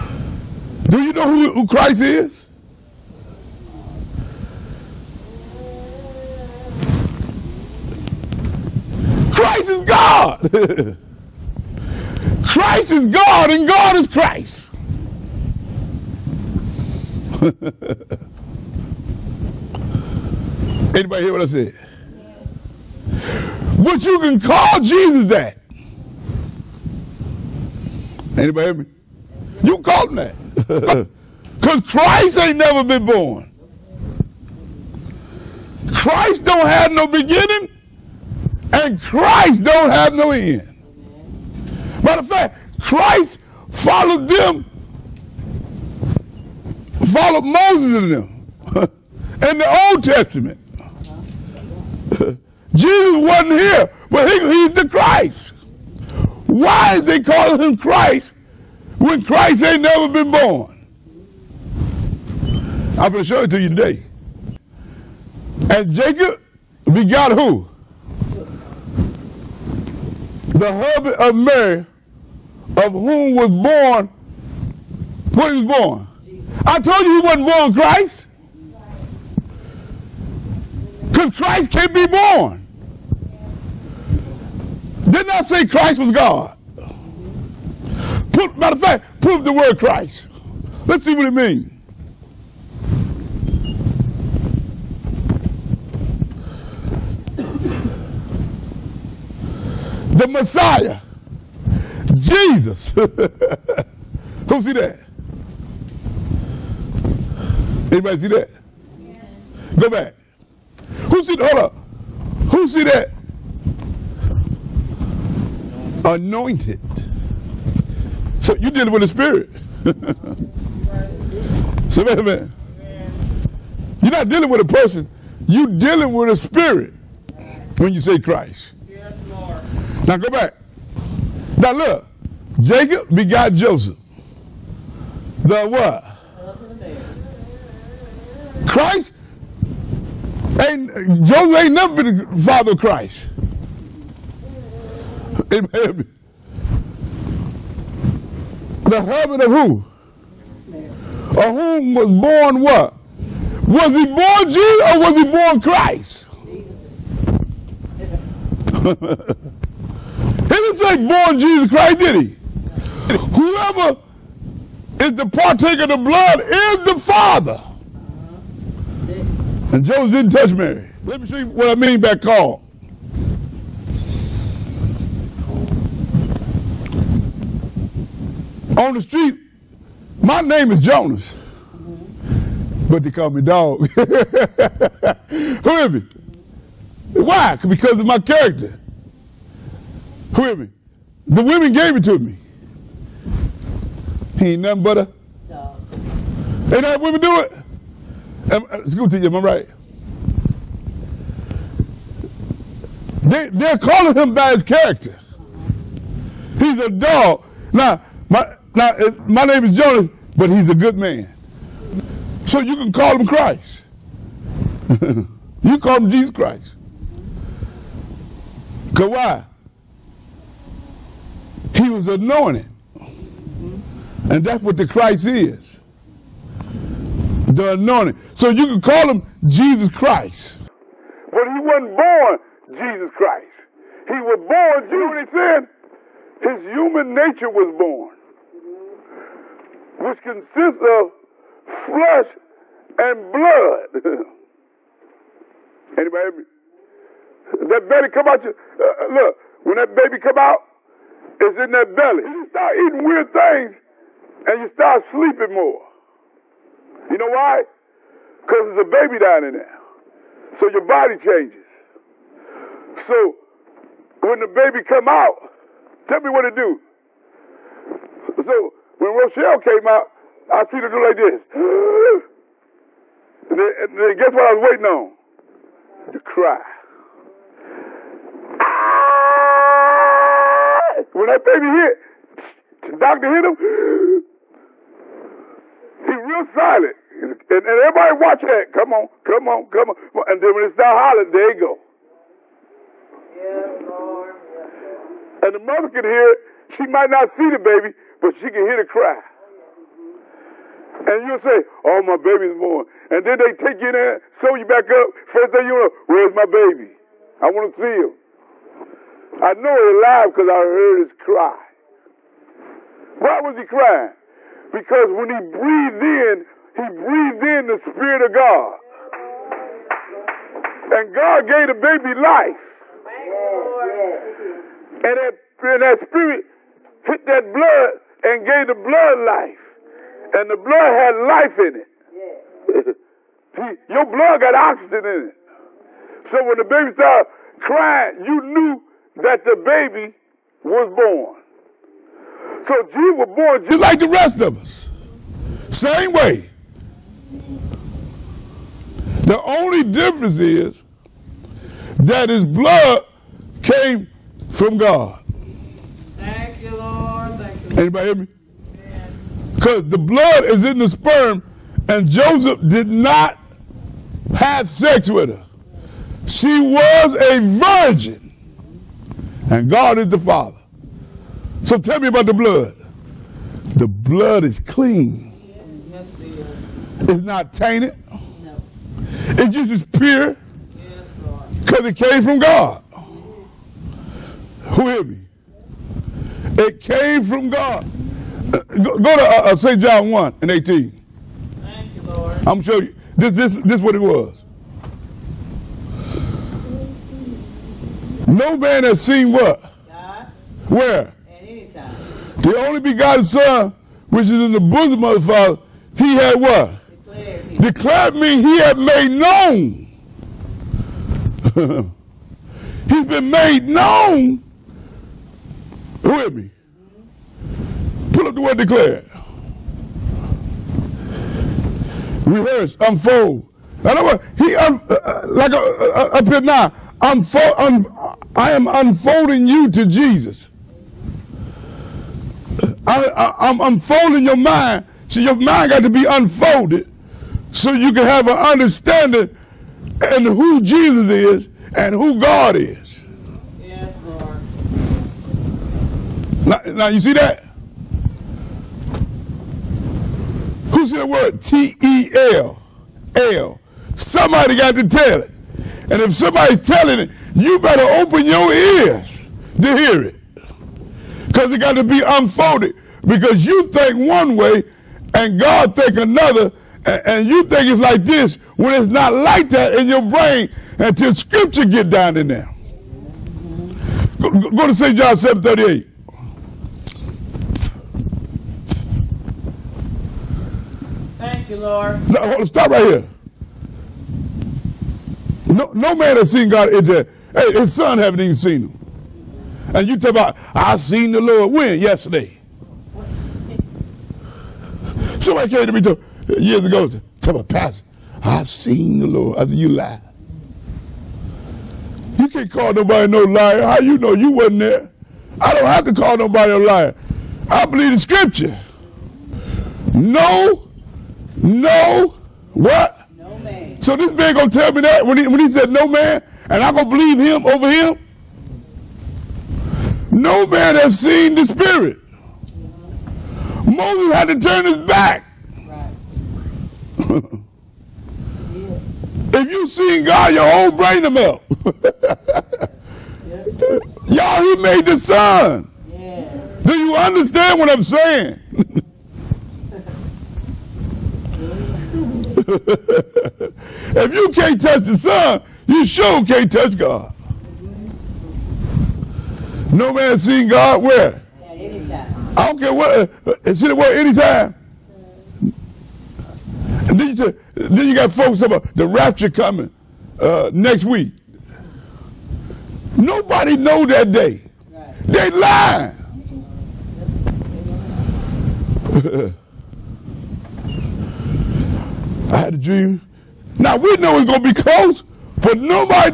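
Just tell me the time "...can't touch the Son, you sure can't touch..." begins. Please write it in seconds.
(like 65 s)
544 s.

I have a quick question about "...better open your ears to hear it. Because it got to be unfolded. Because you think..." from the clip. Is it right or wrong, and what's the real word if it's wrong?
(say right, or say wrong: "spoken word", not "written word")
right.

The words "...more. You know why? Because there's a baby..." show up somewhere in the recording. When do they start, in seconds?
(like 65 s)
255 s.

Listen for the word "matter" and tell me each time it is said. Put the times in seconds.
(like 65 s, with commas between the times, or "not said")
42 s, 88 s.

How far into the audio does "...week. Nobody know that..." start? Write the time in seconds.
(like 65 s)
560 s.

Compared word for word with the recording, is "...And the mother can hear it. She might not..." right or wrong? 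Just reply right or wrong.
right.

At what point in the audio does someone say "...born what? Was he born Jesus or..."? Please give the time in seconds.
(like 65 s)
152 s.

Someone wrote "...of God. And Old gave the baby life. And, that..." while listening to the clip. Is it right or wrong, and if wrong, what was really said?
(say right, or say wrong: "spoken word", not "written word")
wrong: "God", not "Old".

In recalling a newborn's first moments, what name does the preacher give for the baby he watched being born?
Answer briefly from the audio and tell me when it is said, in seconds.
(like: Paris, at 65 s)
Rochelle, at 269 s.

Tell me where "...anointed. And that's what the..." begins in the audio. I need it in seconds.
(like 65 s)
222 s.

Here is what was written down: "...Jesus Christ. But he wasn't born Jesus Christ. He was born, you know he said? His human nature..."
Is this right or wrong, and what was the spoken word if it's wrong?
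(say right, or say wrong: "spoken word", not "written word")
right.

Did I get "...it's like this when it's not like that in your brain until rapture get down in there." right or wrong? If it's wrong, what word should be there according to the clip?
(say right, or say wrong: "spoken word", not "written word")
wrong: "scripture", not "rapture".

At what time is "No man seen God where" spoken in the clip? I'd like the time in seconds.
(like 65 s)
549 s.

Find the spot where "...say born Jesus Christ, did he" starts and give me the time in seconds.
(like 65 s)
160 s.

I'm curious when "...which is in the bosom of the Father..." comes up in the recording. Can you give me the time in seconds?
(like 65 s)
404 s.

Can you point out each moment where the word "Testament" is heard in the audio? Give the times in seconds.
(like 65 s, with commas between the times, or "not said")
50 s.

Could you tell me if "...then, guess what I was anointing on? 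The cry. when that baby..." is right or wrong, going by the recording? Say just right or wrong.
wrong.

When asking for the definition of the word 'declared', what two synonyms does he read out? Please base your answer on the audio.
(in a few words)
Rehearse, unfold.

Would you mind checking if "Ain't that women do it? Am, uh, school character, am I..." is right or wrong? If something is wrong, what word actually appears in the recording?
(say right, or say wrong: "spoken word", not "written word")
wrong: "teacher", not "character".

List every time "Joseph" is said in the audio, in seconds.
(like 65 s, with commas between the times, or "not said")
133 s, 141 s, 169 s, 362 s.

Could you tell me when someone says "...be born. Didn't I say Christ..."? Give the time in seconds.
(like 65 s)
81 s.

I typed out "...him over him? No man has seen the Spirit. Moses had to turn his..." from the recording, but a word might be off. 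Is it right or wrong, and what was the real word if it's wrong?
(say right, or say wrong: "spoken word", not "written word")
right.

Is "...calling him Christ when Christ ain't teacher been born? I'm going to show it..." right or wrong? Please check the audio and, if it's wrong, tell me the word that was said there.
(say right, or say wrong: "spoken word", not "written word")
wrong: "never", not "teacher".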